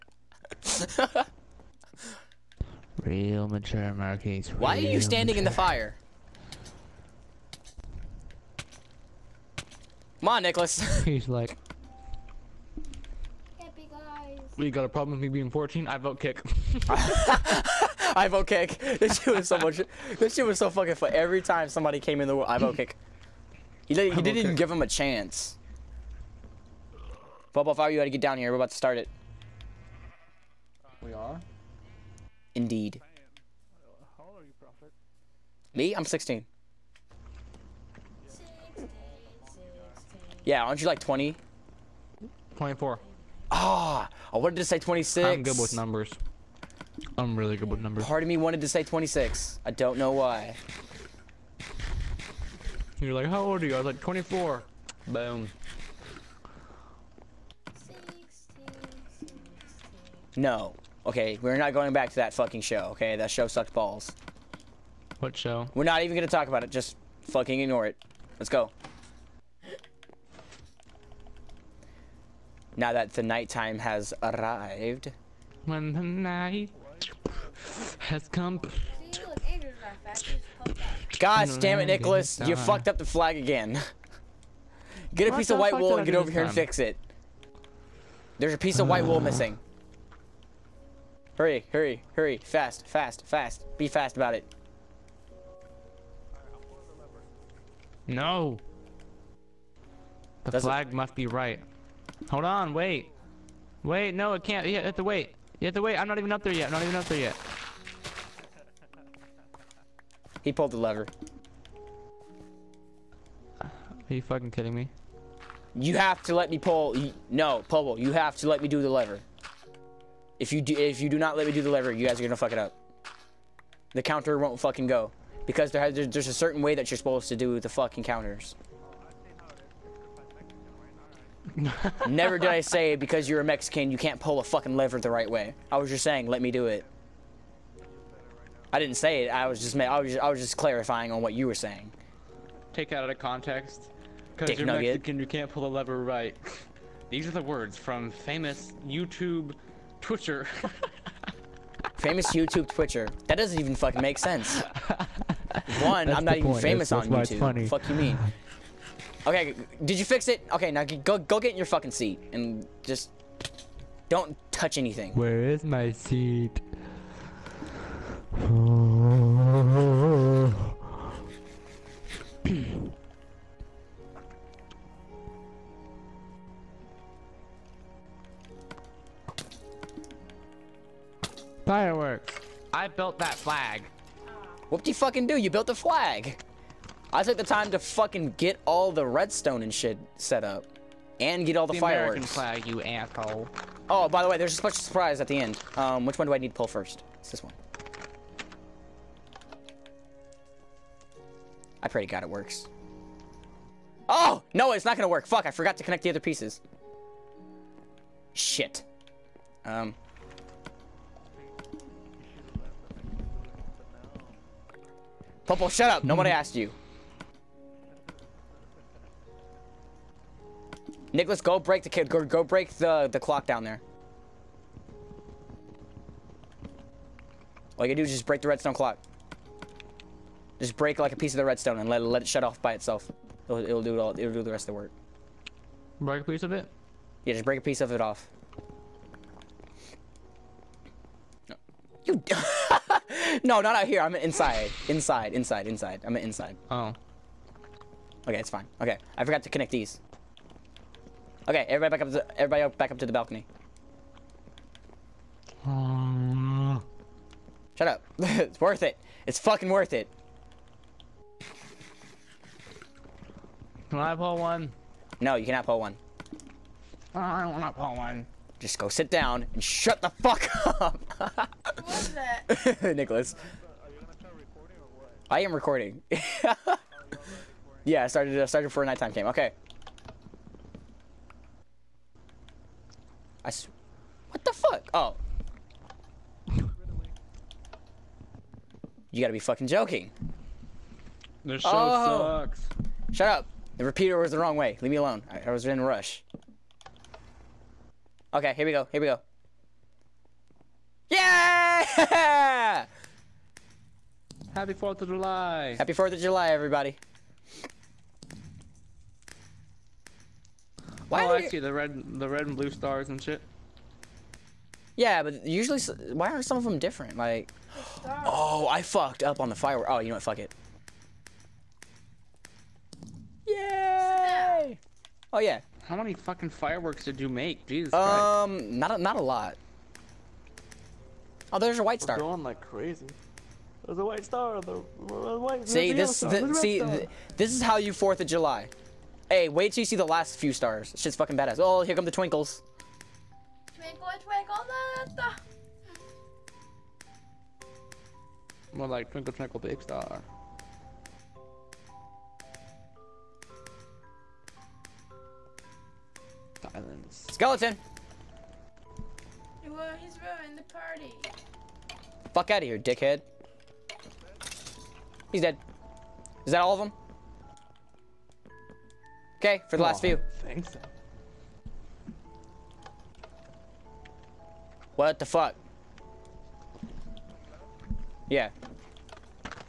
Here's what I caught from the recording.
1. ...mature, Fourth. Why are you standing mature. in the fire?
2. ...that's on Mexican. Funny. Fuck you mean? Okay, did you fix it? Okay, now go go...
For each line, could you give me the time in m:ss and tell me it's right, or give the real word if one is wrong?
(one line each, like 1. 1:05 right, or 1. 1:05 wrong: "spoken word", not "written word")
1. 0:03 wrong: "Marquise", not "Fourth"
2. 2:37 wrong: "YouTube", not "Mexican".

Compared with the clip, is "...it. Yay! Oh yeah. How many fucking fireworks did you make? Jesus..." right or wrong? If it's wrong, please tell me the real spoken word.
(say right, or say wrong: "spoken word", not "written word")
right.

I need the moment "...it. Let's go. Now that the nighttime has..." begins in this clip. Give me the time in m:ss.
1:07.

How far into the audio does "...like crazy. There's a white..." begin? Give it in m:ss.
5:32.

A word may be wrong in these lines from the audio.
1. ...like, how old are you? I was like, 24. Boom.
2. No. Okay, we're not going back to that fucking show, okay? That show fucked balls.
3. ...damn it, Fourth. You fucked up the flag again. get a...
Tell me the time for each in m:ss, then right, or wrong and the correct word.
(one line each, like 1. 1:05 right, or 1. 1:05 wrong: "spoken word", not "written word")
1. 0:53 right
2. 1:00 wrong: "sucked", not "fucked"
3. 1:21 wrong: "Nicholas", not "Fourth".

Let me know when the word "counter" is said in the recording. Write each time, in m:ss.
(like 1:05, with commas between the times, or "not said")
2:04, 2:08.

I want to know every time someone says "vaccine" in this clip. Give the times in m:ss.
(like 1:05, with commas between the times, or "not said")
not said.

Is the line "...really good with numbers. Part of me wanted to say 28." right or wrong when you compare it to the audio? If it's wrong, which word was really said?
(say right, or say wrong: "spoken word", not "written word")
wrong: "26", not "28".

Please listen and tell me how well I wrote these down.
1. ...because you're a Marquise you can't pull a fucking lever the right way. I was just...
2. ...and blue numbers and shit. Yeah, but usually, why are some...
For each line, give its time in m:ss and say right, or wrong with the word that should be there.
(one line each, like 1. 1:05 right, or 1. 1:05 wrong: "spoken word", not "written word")
1. 2:12 wrong: "Mexican", not "Marquise"
2. 5:12 wrong: "stars", not "numbers".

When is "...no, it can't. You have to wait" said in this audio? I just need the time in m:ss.
1:44.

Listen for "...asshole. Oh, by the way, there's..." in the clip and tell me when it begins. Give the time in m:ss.
3:12.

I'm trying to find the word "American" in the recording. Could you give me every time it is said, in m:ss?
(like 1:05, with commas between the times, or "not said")
3:12.